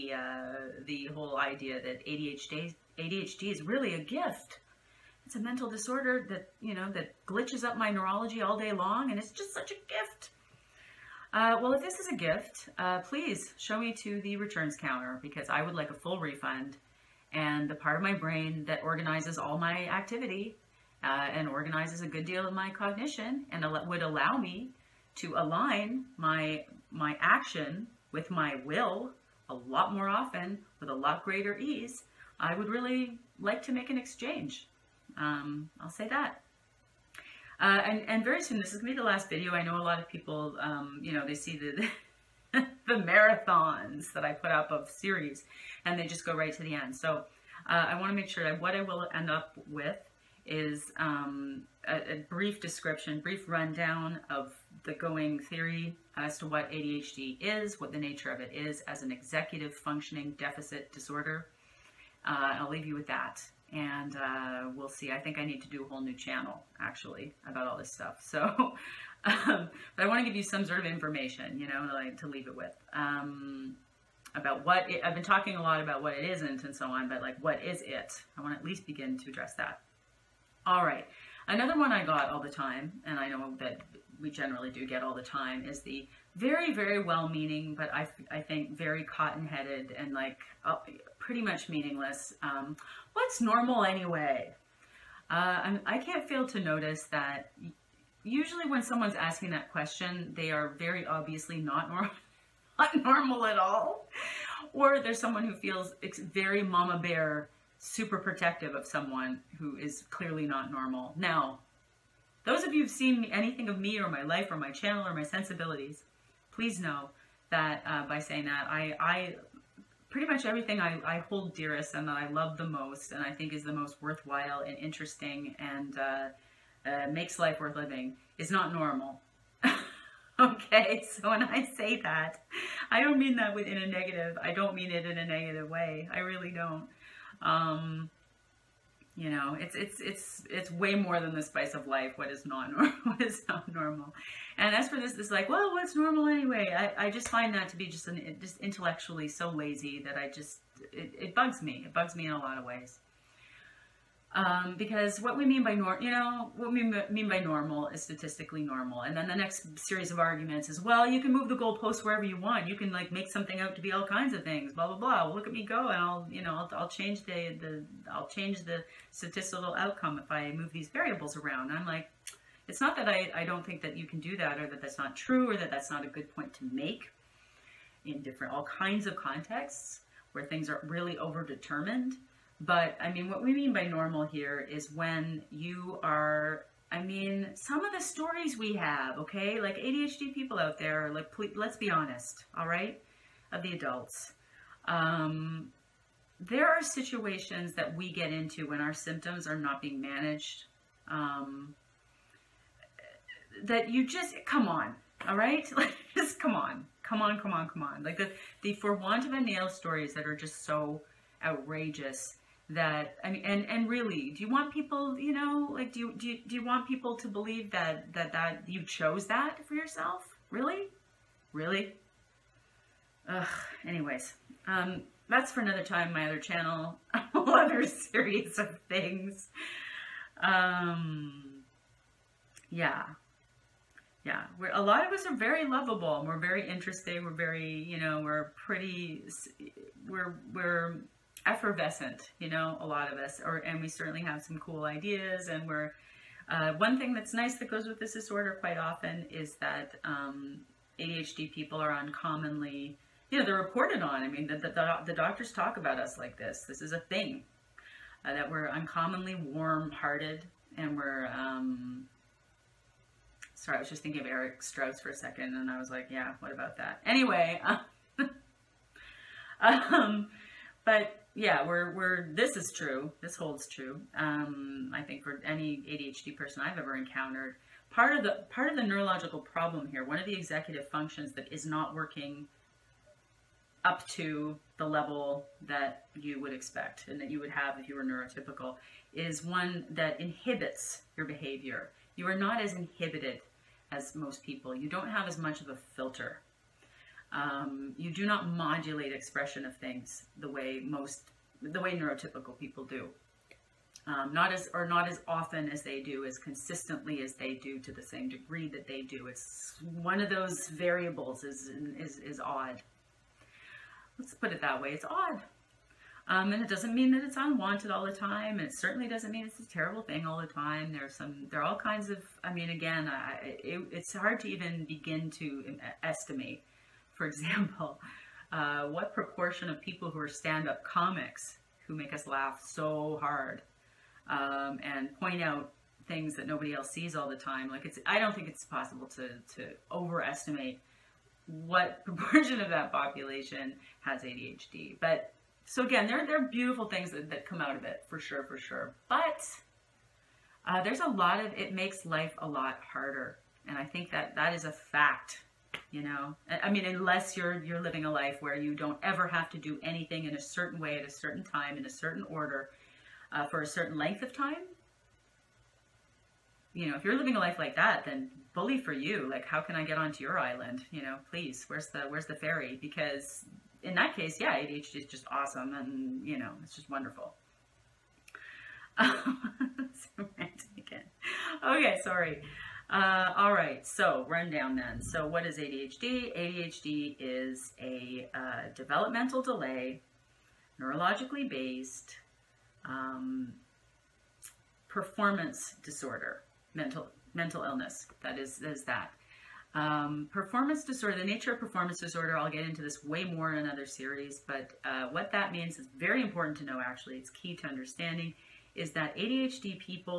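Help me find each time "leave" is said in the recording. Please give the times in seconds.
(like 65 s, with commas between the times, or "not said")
62 s, 72 s.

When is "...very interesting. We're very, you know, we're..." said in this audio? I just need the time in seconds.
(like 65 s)
236 s.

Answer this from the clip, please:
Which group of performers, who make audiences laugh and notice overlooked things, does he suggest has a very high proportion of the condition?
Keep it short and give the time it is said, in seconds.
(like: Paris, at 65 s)
Stand-up comics, at 330 s.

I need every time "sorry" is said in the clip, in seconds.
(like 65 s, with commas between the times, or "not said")
263 s, 382 s.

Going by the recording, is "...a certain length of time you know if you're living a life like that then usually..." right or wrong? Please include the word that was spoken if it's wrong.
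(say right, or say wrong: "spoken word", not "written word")
wrong: "bully", not "usually".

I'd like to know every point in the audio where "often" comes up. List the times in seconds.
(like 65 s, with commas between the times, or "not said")
30 s, 248 s, 305 s.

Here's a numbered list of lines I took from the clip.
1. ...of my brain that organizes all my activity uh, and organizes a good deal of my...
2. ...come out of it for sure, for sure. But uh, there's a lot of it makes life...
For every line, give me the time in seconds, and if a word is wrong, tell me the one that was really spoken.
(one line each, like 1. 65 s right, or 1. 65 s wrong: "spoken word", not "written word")
1. 17 s right
2. 347 s right.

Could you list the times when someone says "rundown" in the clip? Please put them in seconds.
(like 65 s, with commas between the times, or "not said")
53 s, 384 s.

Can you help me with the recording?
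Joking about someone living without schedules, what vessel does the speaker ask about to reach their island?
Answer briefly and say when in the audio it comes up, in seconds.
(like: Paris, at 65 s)
The ferry, at 372 s.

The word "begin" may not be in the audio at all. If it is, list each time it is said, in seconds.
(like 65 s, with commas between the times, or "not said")
78 s, 324 s.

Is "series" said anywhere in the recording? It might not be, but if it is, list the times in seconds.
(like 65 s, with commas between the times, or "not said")
44 s, 159 s, 227 s, 403 s.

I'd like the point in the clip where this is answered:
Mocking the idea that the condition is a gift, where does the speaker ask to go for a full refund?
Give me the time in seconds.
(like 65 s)
14 s.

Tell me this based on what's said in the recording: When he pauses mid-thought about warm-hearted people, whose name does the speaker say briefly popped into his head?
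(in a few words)
Eric Strauss.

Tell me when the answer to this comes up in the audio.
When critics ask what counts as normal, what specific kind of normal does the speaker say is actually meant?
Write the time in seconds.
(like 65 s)
158 s.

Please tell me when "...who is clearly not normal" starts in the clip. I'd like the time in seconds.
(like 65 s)
109 s.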